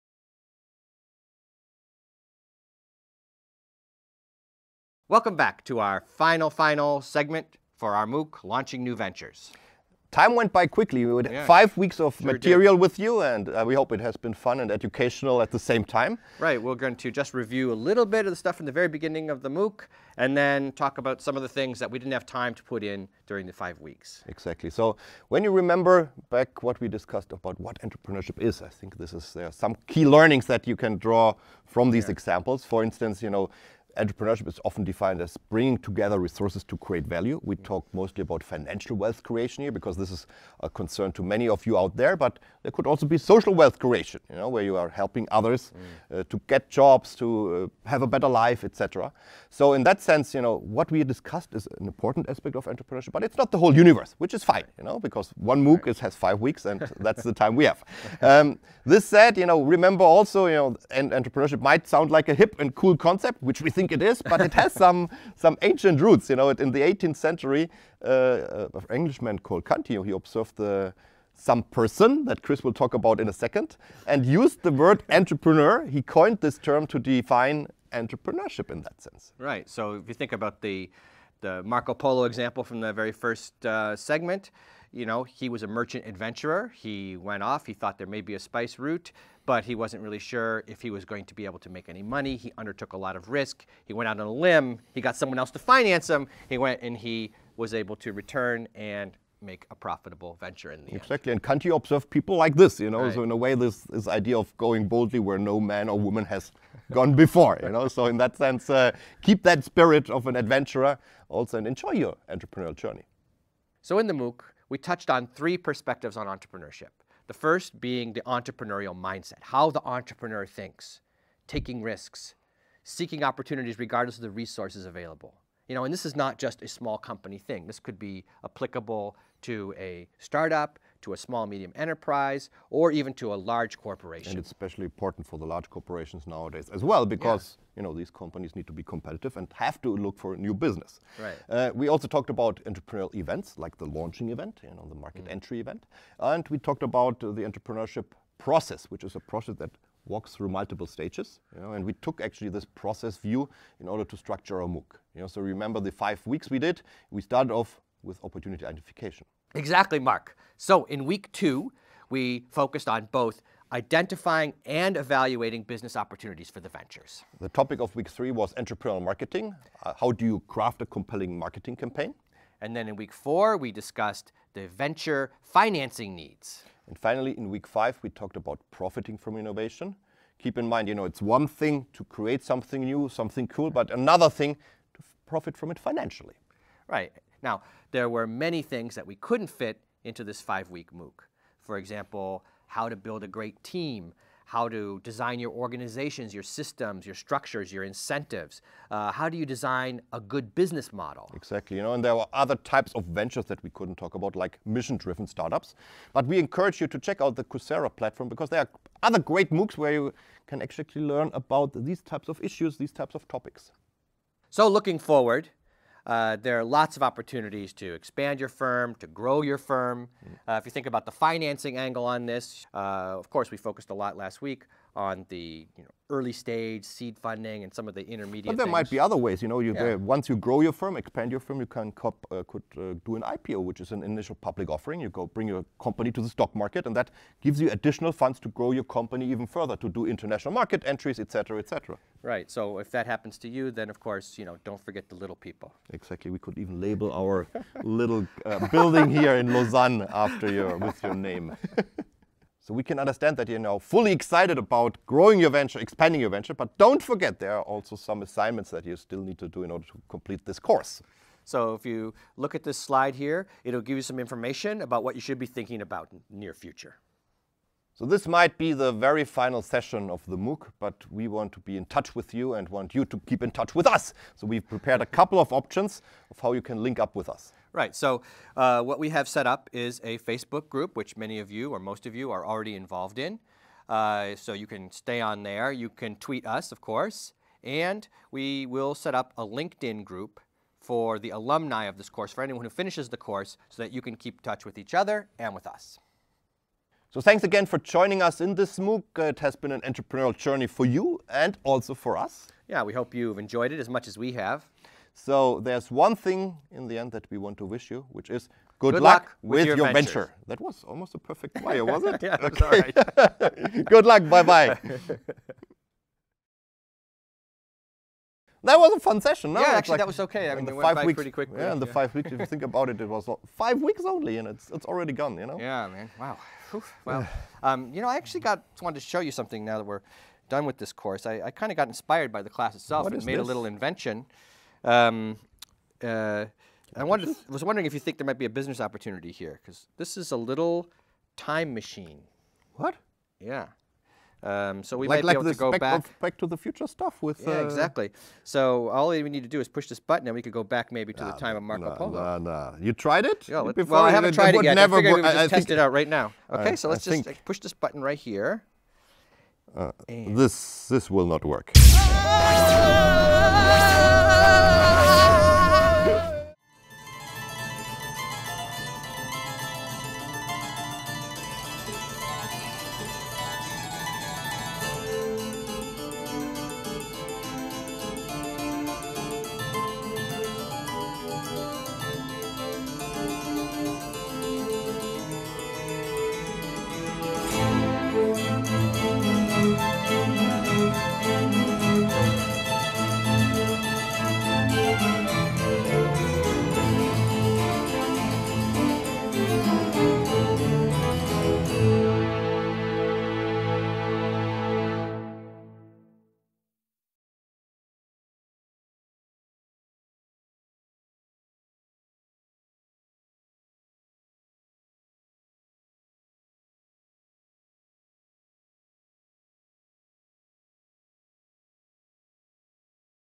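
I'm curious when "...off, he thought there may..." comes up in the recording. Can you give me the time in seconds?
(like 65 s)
87 s.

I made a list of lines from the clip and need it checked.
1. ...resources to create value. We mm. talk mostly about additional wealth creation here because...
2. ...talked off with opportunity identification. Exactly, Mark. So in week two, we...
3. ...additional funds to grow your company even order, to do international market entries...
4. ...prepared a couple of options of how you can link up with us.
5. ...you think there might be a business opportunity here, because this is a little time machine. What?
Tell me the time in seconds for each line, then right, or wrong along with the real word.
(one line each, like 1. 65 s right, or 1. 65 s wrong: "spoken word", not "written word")
1. 36 s wrong: "financial", not "additional"
2. 157 s wrong: "started", not "talked"
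3. 237 s wrong: "further", not "order"
4. 274 s right
5. 337 s right.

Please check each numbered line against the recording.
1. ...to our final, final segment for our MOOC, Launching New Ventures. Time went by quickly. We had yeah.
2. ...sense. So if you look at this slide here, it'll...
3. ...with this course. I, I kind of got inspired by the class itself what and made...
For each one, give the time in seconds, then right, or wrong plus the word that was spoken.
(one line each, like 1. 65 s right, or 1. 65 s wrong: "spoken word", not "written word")
1. 5 s right
2. 260 s wrong: "course", not "sense"
3. 330 s right.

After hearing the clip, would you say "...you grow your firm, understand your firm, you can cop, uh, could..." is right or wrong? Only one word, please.
wrong.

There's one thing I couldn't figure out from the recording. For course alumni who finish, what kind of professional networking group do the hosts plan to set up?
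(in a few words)
LinkedIn group.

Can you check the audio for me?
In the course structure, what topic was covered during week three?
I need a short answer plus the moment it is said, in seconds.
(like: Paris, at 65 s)
Entrepreneurial marketing, at 168 s.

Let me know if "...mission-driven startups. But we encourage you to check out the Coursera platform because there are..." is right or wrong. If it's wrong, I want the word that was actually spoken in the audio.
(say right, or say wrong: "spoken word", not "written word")
right.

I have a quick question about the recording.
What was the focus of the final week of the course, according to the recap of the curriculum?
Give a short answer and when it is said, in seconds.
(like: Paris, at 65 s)
Profiting from innovation, at 178 s.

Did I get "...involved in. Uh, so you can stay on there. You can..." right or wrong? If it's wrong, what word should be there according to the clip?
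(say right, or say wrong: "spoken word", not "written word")
right.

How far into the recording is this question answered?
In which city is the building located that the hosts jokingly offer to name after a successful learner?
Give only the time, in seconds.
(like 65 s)
249 s.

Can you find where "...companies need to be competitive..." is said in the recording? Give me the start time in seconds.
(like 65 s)
138 s.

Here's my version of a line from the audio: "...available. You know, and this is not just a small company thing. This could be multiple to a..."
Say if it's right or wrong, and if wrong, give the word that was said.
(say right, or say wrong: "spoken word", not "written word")
wrong: "applicable", not "multiple".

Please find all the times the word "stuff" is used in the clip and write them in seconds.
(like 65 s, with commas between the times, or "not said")
18 s, 346 s.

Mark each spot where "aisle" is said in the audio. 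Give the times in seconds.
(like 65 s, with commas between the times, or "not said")
not said.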